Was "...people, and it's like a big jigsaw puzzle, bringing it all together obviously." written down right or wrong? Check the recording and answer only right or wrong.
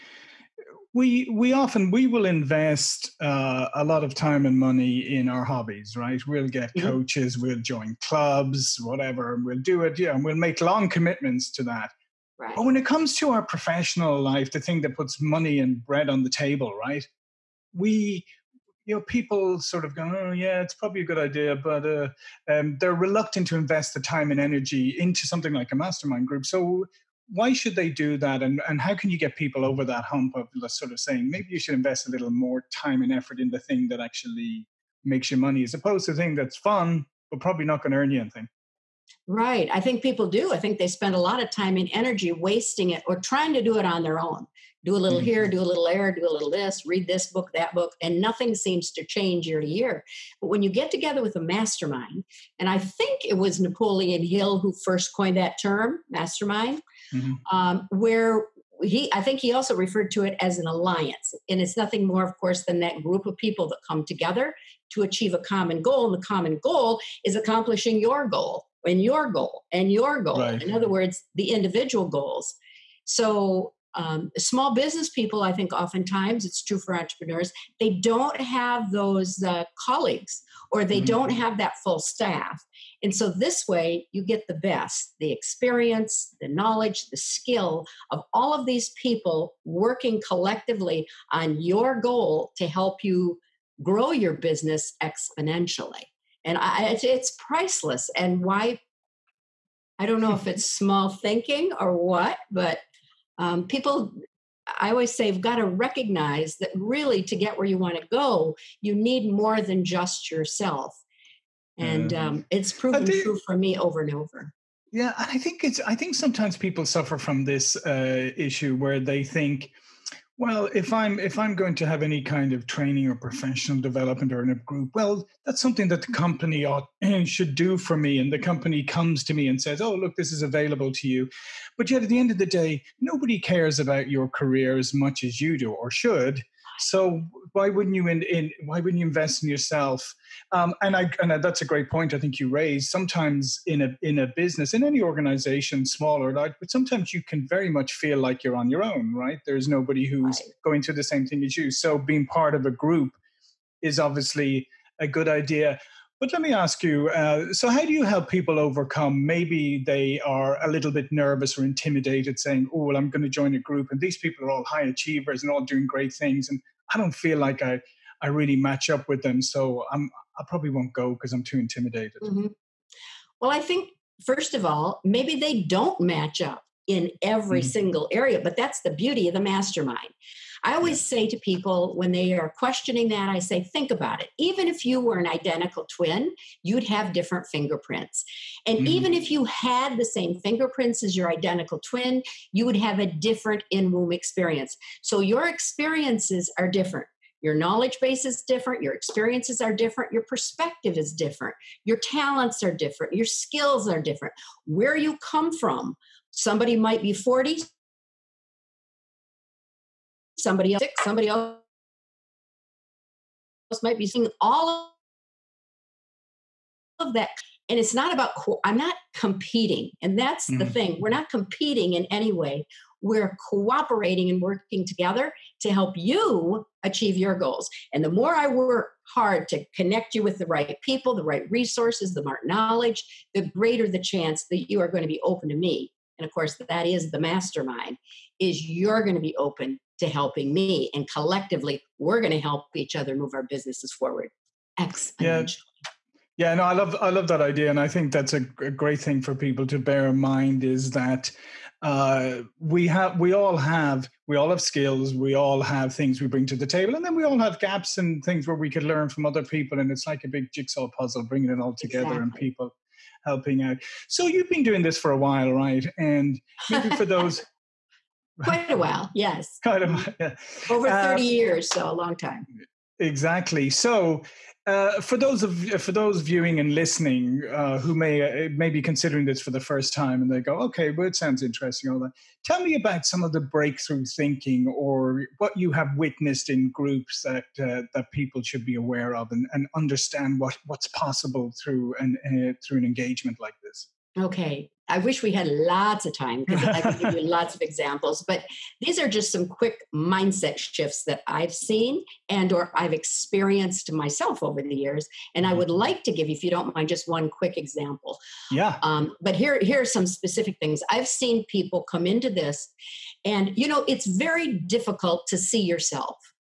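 wrong.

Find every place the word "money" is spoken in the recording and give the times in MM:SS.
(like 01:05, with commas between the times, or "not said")
00:04, 00:15, 00:35.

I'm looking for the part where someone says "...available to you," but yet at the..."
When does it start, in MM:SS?
02:10.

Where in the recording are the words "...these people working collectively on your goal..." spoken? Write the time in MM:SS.
01:28.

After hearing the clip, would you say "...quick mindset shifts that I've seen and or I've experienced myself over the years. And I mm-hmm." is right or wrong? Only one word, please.
right.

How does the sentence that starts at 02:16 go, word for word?
So why wouldn't you in, in why wouldn't you invest in yourself?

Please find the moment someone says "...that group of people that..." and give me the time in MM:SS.
01:02.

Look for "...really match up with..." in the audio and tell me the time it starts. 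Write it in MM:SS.
02:48.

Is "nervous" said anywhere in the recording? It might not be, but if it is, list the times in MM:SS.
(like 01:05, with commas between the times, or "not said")
02:41.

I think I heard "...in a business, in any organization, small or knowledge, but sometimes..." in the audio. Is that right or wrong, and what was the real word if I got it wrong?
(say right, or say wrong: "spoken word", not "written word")
wrong: "large", not "knowledge".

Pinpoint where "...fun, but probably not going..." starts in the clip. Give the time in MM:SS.
00:36.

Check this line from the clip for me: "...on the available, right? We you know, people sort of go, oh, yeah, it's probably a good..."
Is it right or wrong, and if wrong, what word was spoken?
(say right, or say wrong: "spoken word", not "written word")
wrong: "table", not "available".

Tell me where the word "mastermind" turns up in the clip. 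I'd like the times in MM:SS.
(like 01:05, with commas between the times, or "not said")
00:25, 00:51, 00:56, 02:59, 03:57.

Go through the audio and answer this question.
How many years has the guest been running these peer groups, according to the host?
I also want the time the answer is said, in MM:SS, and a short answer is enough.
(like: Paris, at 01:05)
30, at 04:31.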